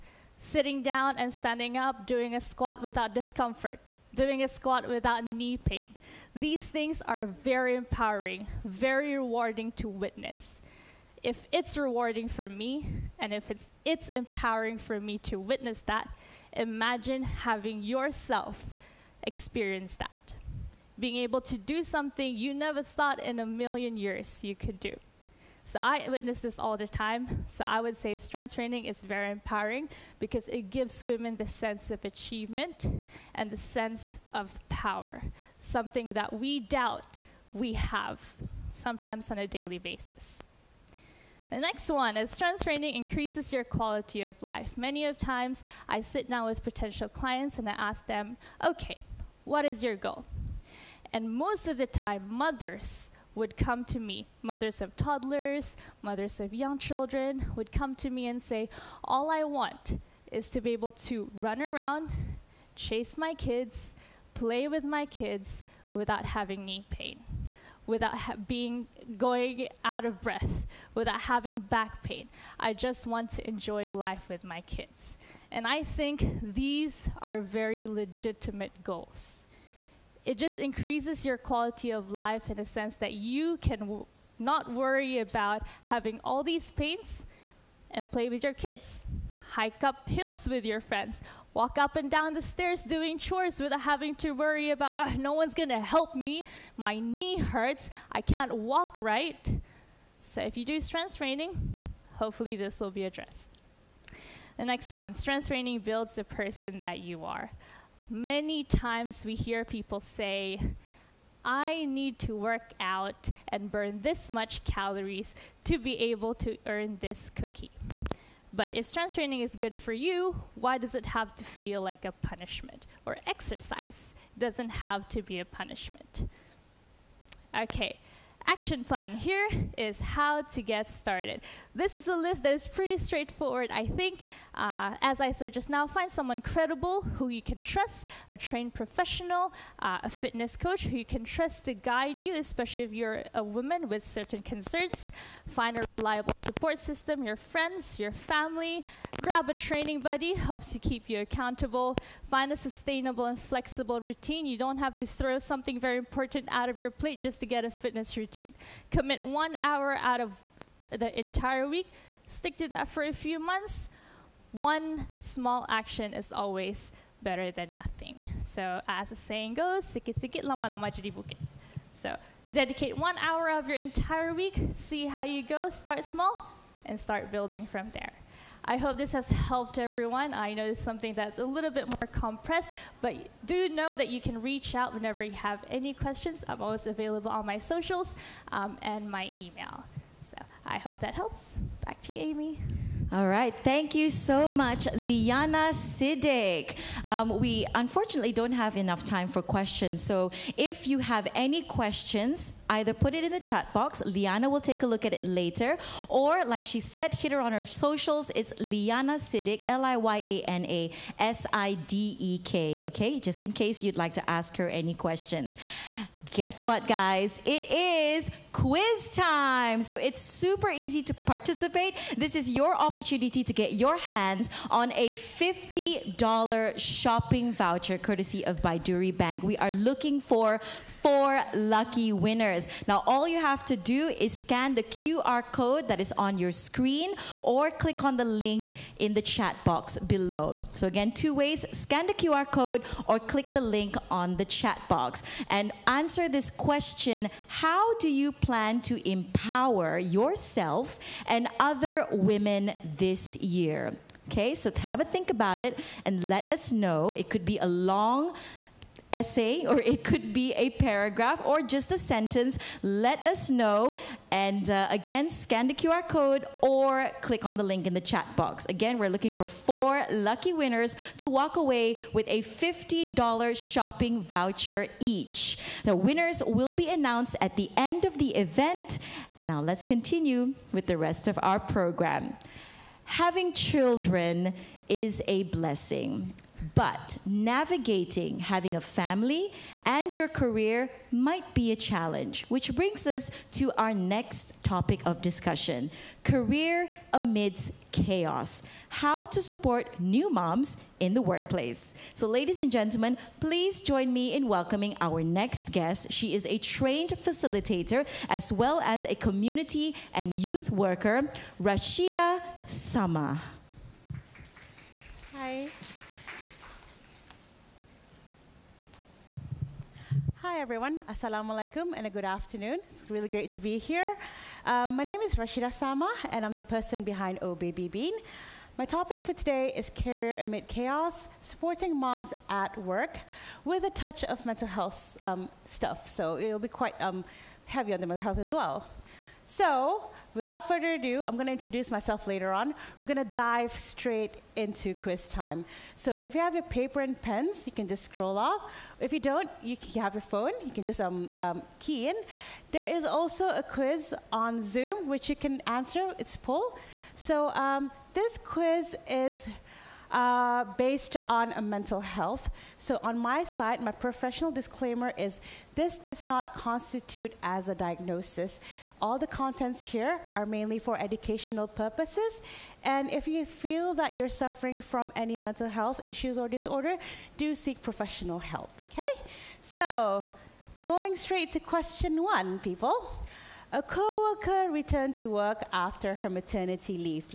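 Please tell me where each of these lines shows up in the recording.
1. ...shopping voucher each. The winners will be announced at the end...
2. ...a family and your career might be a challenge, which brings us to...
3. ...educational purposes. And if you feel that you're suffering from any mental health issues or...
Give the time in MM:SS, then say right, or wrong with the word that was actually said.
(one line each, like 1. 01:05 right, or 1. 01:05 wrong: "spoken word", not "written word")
1. 04:33 right
2. 04:48 right
3. 06:10 right.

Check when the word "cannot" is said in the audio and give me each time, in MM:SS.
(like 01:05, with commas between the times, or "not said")
not said.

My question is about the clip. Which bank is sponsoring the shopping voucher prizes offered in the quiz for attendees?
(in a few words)
Baiduri Bank.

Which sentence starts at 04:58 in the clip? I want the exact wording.
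How to support new moms in the workplace.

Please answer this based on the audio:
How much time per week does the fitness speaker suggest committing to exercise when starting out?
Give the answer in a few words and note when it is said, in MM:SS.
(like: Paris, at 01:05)
1 hour, at 02:38.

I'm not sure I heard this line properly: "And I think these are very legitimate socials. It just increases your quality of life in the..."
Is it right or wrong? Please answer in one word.
wrong.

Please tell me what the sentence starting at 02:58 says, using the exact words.
I hope this has helped everyone.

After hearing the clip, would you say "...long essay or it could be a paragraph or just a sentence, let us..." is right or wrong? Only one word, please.
right.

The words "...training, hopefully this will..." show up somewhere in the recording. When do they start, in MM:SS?
01:41.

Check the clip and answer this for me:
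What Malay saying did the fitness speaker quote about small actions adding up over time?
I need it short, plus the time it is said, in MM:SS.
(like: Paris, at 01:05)
sikit-sikit lama-lama jadi bukit, at 02:49.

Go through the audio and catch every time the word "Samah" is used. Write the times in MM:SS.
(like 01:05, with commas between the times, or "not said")
05:12, 05:25.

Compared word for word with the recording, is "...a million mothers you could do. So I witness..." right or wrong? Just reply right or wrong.
wrong.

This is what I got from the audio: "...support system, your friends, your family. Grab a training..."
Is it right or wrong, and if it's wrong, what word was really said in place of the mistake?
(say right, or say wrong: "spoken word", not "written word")
right.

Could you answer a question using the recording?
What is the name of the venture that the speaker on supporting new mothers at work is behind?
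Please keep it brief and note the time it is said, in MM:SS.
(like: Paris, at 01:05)
Oh Baby Bean, at 05:27.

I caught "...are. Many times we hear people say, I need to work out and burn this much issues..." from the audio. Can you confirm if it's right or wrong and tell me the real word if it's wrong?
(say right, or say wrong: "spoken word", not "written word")
wrong: "calories", not "issues".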